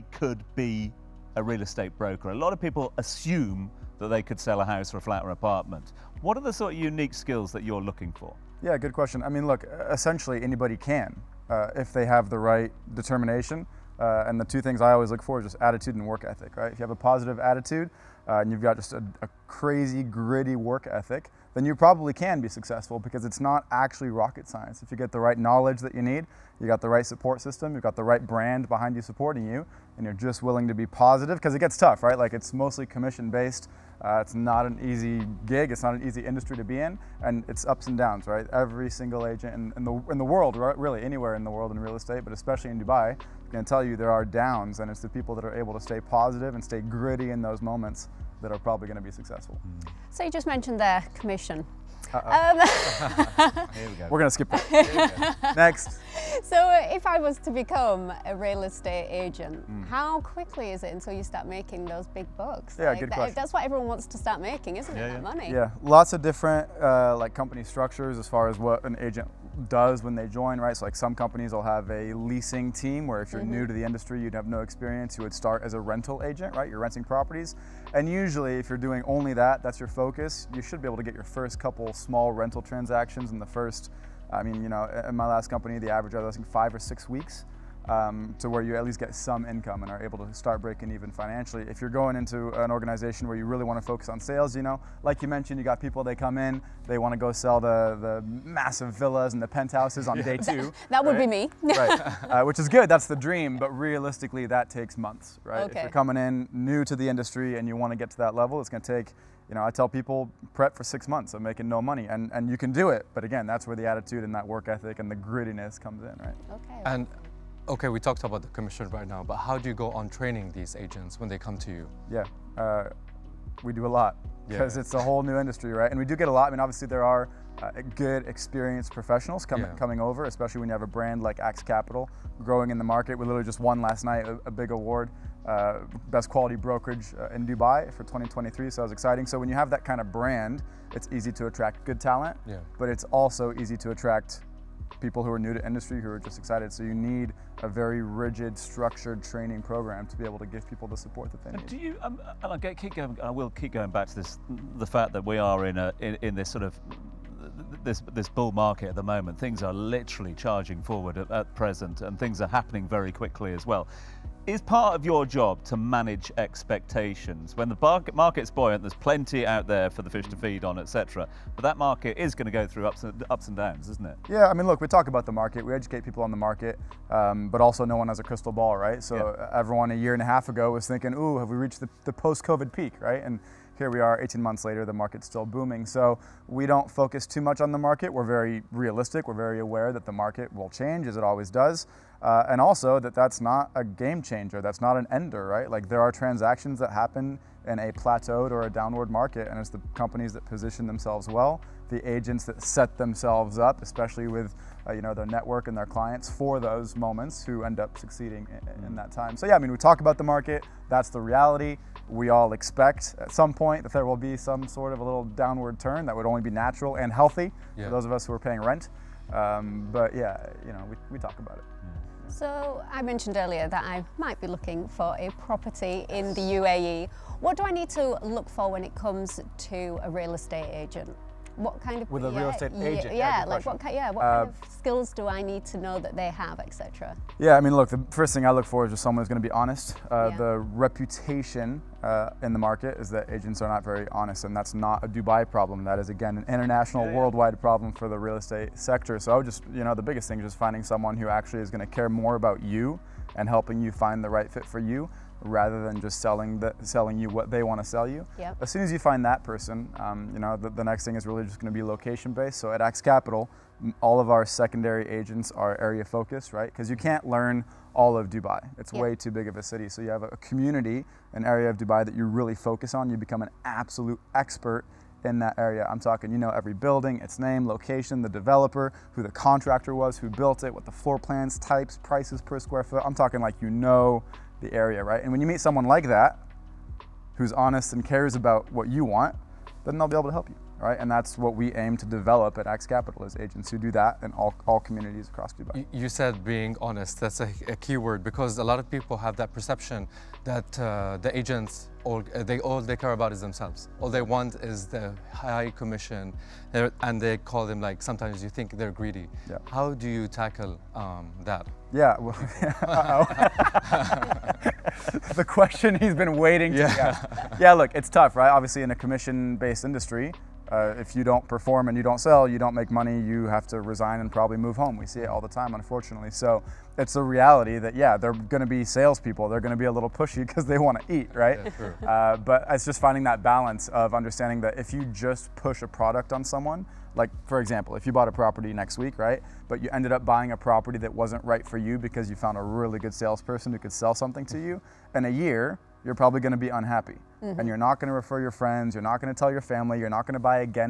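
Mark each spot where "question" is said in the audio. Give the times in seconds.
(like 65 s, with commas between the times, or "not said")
8 s, 63 s, 315 s.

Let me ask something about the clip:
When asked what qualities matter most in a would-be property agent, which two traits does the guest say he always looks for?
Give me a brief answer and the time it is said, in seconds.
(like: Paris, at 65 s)
attitude and work ethic, at 15 s.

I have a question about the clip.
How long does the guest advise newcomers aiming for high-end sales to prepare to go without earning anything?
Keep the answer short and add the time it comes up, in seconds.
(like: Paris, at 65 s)
6 months, at 110 s.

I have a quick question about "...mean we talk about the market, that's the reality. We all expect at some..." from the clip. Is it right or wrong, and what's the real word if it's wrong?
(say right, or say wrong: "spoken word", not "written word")
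right.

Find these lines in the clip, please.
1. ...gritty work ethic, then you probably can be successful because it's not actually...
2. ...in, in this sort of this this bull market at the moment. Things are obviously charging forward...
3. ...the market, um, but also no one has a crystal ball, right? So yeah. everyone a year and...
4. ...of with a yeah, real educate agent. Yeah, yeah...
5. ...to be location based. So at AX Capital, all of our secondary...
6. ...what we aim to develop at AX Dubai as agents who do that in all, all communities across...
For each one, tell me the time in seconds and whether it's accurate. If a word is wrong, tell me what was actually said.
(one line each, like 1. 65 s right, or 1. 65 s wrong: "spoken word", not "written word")
1. 20 s right
2. 156 s wrong: "literally", not "obviously"
3. 176 s right
4. 232 s wrong: "estate", not "educate"
5. 261 s right
6. 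291 s wrong: "Capital", not "Dubai".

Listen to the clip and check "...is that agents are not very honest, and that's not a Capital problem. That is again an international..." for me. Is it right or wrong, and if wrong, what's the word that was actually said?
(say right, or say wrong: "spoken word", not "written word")
wrong: "Dubai", not "Capital".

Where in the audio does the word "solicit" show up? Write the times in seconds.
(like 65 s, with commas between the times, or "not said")
not said.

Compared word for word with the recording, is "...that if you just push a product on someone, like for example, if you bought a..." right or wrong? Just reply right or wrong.
right.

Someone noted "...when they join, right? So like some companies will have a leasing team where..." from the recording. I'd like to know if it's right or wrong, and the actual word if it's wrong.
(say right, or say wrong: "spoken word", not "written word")
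right.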